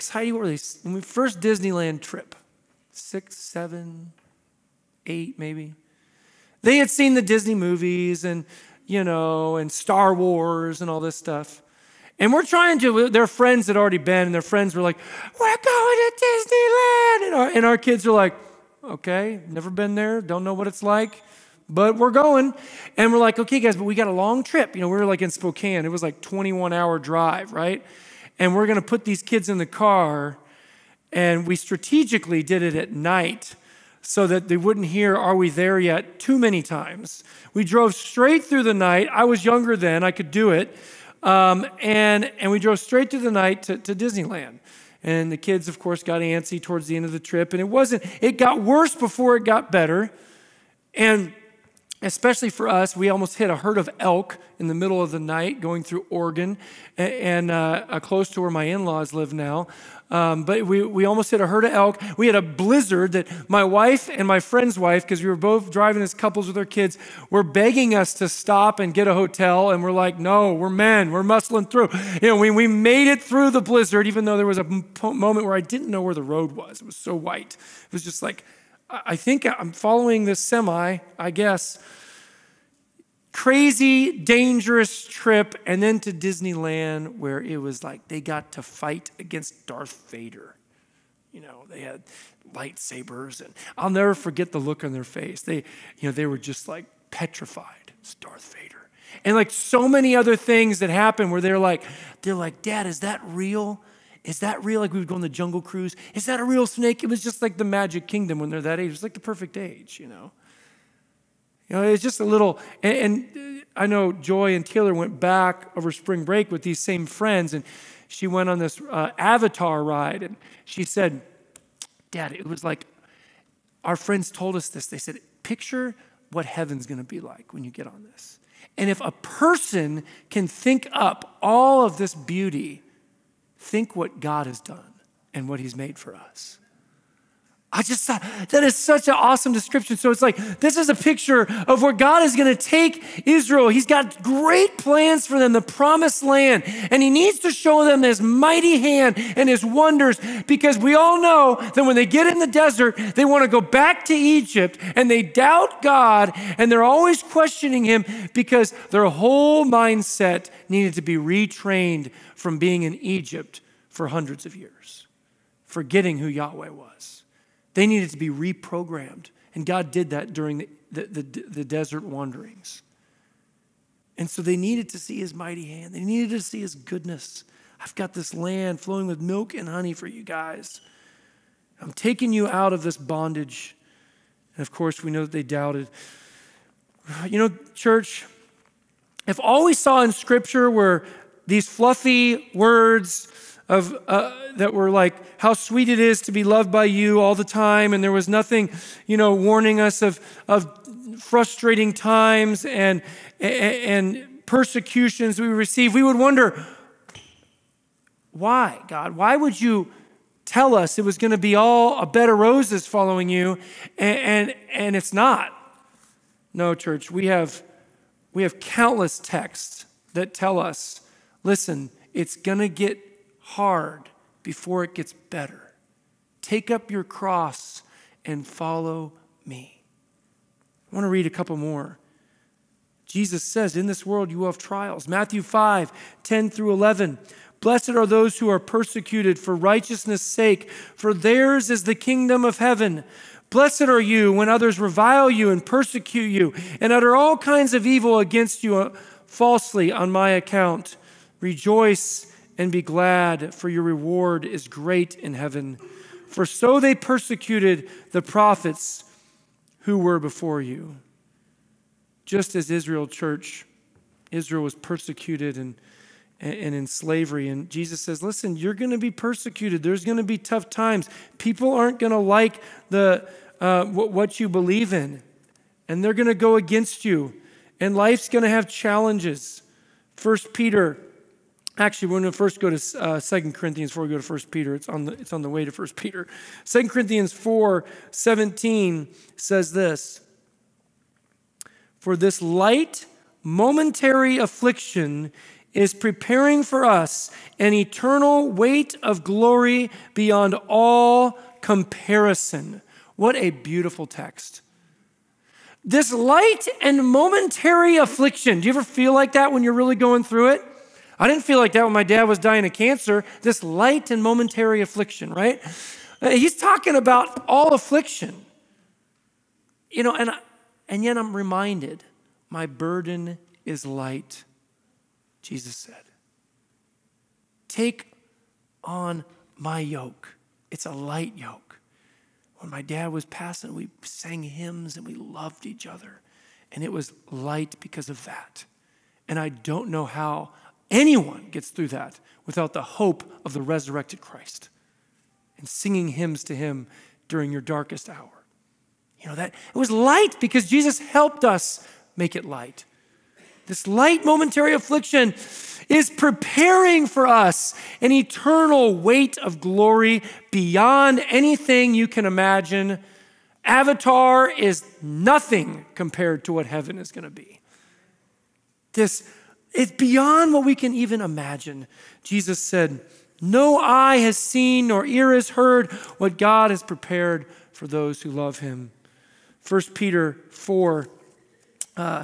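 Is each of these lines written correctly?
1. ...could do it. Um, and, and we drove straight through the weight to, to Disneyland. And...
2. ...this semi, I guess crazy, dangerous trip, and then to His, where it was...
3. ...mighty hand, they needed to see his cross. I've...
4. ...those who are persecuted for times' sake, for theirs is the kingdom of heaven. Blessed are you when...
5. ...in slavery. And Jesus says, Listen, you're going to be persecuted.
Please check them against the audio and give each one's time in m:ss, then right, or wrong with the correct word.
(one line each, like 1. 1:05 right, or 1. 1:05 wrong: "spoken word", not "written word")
1. 0:40 wrong: "night", not "weight"
2. 1:20 wrong: "Disneyland", not "His"
3. 2:55 wrong: "goodness", not "cross"
4. 3:58 wrong: "righteousness", not "times"
5. 4:26 right.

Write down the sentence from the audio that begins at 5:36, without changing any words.
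And it was light because of that.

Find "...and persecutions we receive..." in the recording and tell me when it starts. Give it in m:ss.
3:23.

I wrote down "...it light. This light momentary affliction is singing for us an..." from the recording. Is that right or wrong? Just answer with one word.
wrong.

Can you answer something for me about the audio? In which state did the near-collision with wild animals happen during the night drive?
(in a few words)
Oregon.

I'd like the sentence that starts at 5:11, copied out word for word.
I didn't feel like that when my dad was dying of cancer, this light and momentary affliction, right?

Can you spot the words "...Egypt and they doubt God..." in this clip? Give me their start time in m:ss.
2:34.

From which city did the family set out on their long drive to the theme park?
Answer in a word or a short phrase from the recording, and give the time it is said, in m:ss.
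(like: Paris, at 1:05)
Spokane, at 0:25.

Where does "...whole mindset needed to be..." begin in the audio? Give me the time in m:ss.
2:39.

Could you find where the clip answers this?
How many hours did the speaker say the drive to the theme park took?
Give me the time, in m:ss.
0:26.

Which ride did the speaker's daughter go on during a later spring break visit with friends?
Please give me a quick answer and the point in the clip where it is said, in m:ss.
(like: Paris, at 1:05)
Avatar ride, at 1:59.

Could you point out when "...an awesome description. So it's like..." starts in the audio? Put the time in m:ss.
2:19.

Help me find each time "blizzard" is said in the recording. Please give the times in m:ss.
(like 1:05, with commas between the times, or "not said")
1:02, 1:13.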